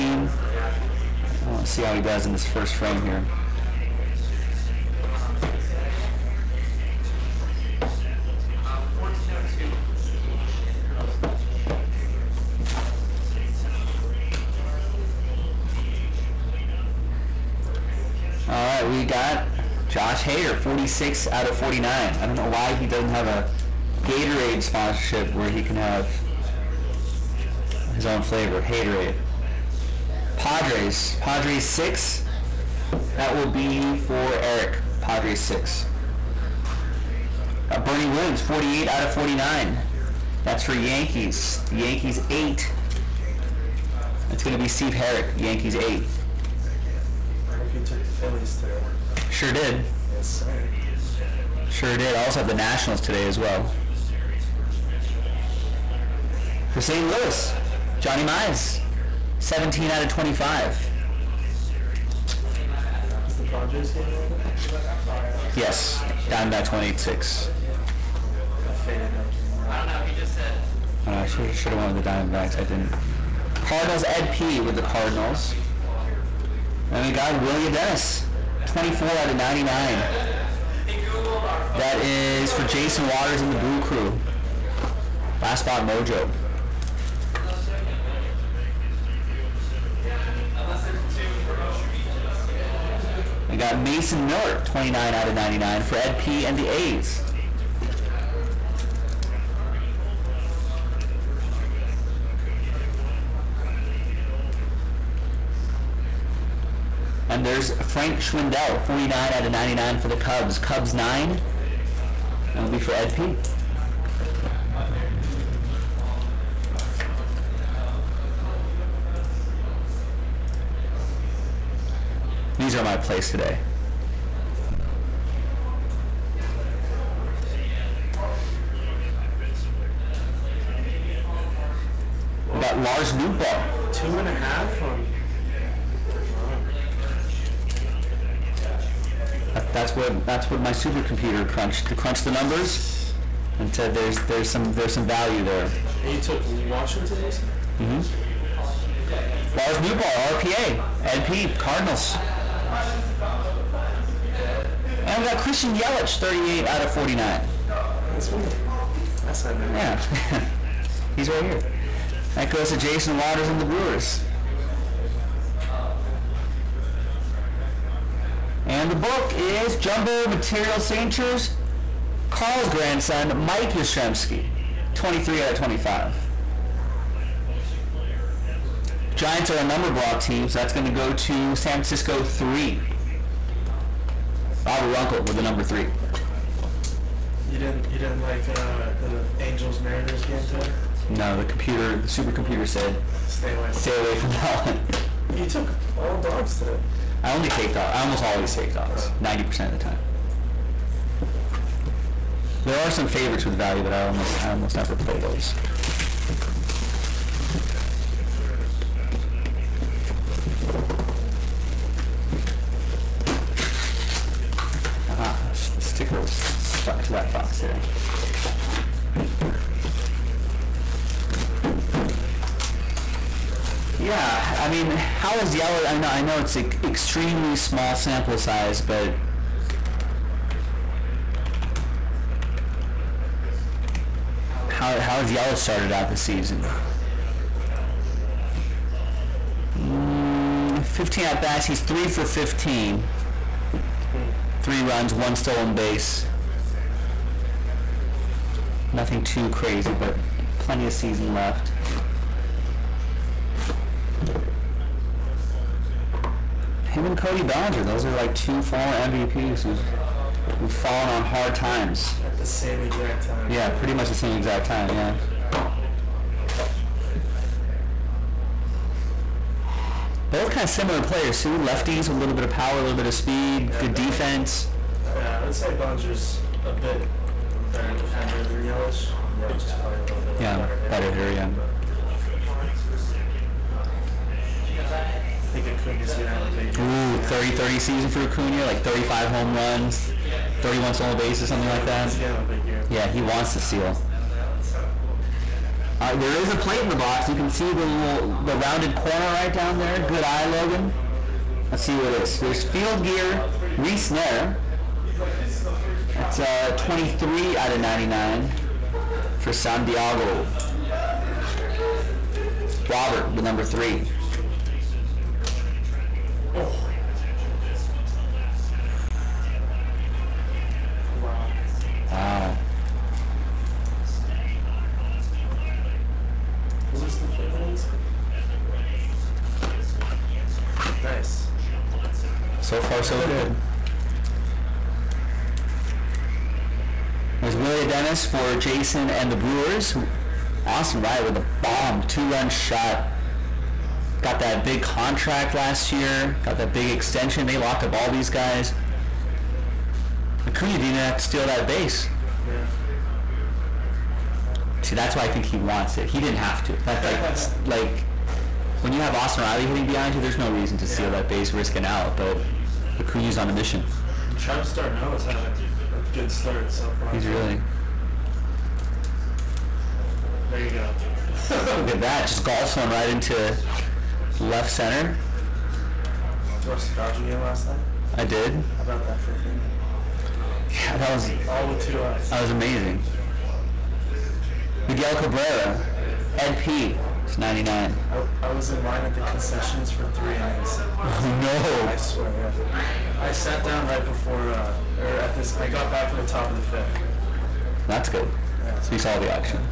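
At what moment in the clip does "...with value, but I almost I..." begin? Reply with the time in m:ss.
3:23.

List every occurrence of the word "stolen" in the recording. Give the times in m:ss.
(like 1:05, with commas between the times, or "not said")
4:05, 4:50.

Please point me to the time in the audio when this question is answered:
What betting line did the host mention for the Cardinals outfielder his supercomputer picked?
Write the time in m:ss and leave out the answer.
2:13.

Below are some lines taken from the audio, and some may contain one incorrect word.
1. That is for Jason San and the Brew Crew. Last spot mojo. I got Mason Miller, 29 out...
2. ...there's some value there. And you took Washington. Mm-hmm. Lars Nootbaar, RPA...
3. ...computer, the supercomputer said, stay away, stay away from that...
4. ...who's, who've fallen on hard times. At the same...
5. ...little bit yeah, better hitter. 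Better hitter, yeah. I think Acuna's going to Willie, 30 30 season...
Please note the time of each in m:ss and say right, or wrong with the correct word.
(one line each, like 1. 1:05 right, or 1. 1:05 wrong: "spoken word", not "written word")
1. 1:21 wrong: "Waters", not "San"
2. 2:24 right
3. 3:11 right
4. 4:19 right
5. 4:40 wrong: "Ooh", not "Willie".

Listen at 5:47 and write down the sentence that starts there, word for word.
They locked up all these guys.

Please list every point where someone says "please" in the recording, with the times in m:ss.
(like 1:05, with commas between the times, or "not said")
not said.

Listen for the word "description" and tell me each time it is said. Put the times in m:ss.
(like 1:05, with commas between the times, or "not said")
not said.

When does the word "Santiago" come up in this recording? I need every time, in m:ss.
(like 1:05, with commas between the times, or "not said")
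5:09.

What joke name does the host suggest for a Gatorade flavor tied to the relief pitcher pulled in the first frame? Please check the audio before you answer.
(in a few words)
Haterade.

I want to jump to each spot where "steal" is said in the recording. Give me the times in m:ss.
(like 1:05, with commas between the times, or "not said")
4:53, 5:51, 6:00.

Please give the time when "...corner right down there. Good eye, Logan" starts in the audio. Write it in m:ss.
4:58.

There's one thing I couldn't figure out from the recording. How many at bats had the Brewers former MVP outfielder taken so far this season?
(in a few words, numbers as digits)
15.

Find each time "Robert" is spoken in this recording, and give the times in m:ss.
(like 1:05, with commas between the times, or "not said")
3:04, 5:12.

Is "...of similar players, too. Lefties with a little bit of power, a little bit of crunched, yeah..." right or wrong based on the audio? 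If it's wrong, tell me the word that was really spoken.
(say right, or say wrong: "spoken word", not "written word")
wrong: "speed", not "crunched".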